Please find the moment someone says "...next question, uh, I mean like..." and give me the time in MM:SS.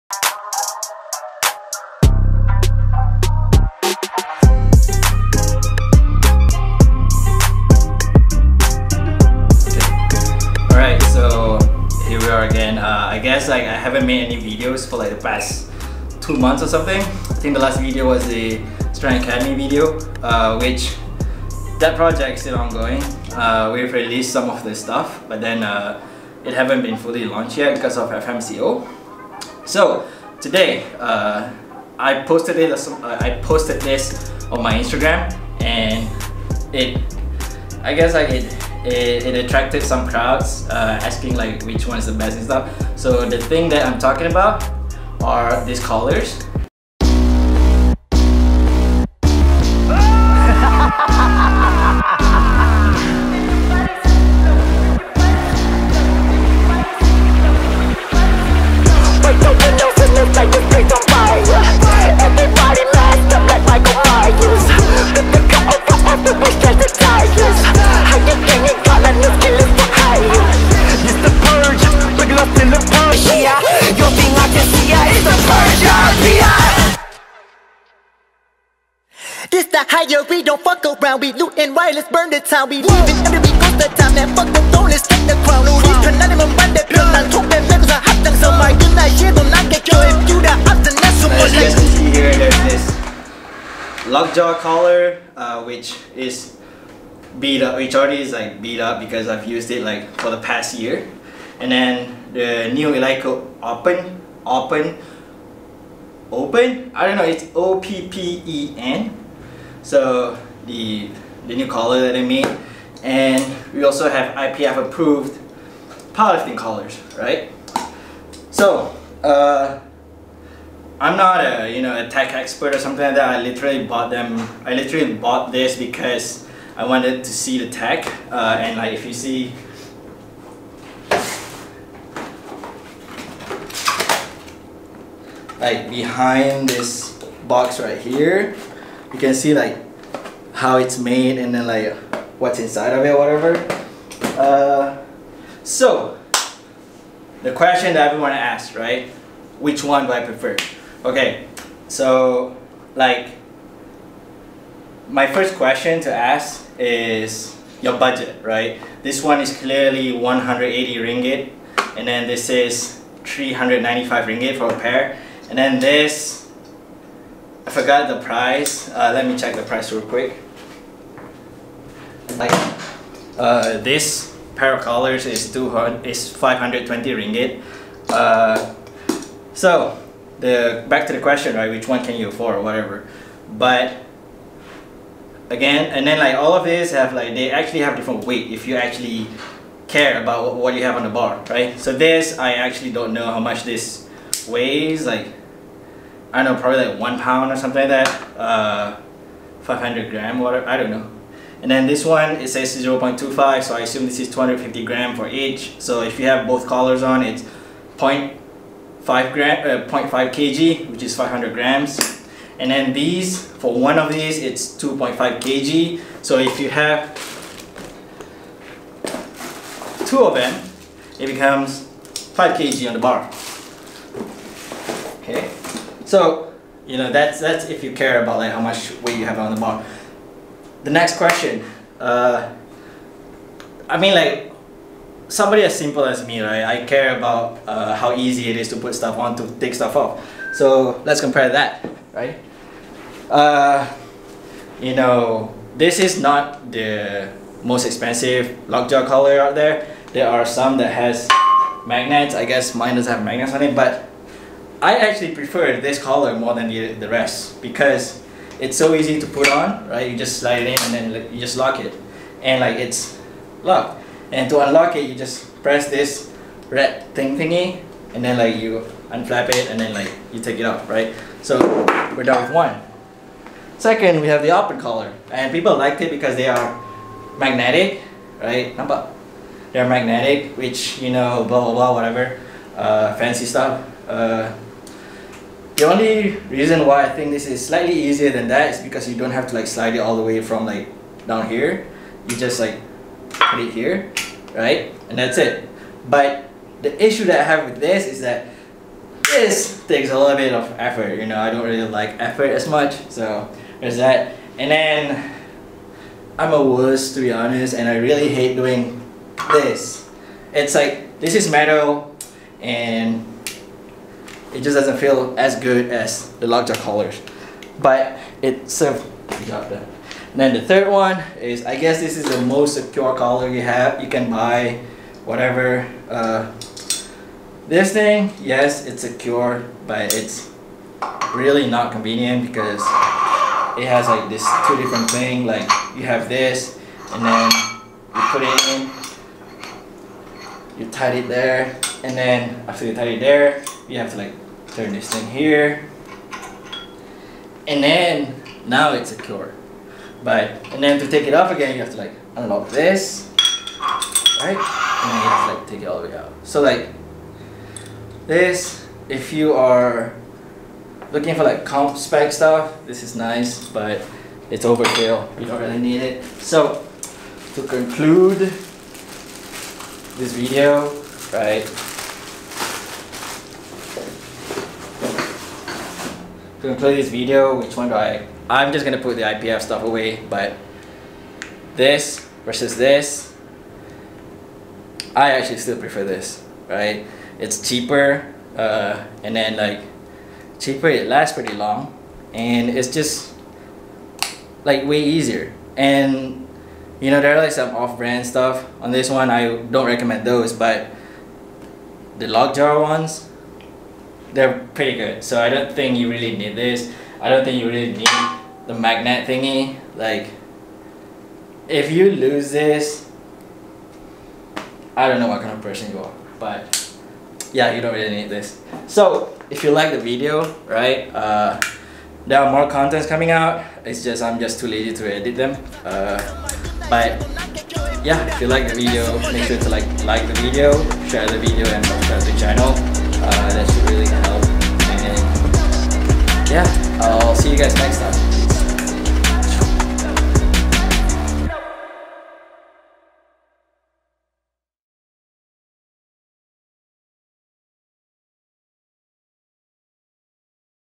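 03:50.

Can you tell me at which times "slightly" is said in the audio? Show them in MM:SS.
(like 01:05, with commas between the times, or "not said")
04:47.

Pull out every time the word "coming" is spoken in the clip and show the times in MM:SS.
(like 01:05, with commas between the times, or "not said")
07:03.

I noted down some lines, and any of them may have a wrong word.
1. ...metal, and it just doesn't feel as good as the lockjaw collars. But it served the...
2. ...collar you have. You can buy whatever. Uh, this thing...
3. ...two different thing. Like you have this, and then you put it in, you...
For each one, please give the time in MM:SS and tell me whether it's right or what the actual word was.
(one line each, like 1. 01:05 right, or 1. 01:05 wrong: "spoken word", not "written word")
1. 05:11 right
2. 05:23 right
3. 05:34 right.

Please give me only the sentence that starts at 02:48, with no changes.
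Uh, let me check the price real quick.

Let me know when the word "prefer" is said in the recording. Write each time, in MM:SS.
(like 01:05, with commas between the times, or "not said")
02:30, 04:15, 06:25.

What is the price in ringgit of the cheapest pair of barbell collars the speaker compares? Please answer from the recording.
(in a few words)
180 ringgit.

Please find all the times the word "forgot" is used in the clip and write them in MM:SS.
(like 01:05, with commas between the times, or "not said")
02:47.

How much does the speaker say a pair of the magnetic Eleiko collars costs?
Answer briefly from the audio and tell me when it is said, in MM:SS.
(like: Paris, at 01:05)
395 ringgit, at 02:43.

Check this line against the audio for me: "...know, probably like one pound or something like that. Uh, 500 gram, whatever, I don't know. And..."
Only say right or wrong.
right.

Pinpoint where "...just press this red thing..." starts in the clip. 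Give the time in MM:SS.
04:25.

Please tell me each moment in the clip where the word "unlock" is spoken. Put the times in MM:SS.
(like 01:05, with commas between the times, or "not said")
04:24, 05:52.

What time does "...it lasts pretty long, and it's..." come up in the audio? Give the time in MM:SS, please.
06:30.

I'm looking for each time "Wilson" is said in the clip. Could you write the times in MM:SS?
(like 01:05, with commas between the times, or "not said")
not said.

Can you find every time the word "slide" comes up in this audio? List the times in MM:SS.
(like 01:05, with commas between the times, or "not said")
04:20, 04:49.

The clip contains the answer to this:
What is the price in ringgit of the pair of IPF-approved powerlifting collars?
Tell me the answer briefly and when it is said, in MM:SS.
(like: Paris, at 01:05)
520 ringgit, at 02:56.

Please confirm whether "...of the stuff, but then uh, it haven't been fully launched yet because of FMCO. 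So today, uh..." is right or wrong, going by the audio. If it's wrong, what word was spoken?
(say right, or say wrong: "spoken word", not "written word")
right.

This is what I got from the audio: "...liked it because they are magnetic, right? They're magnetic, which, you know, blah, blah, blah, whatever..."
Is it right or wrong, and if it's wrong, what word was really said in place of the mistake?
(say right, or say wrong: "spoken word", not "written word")
right.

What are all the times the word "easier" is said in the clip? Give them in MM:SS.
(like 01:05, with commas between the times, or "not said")
04:47, 06:35.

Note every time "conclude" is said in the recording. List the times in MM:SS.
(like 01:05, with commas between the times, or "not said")
06:07, 06:16.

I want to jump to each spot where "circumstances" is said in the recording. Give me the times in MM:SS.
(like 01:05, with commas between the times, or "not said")
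not said.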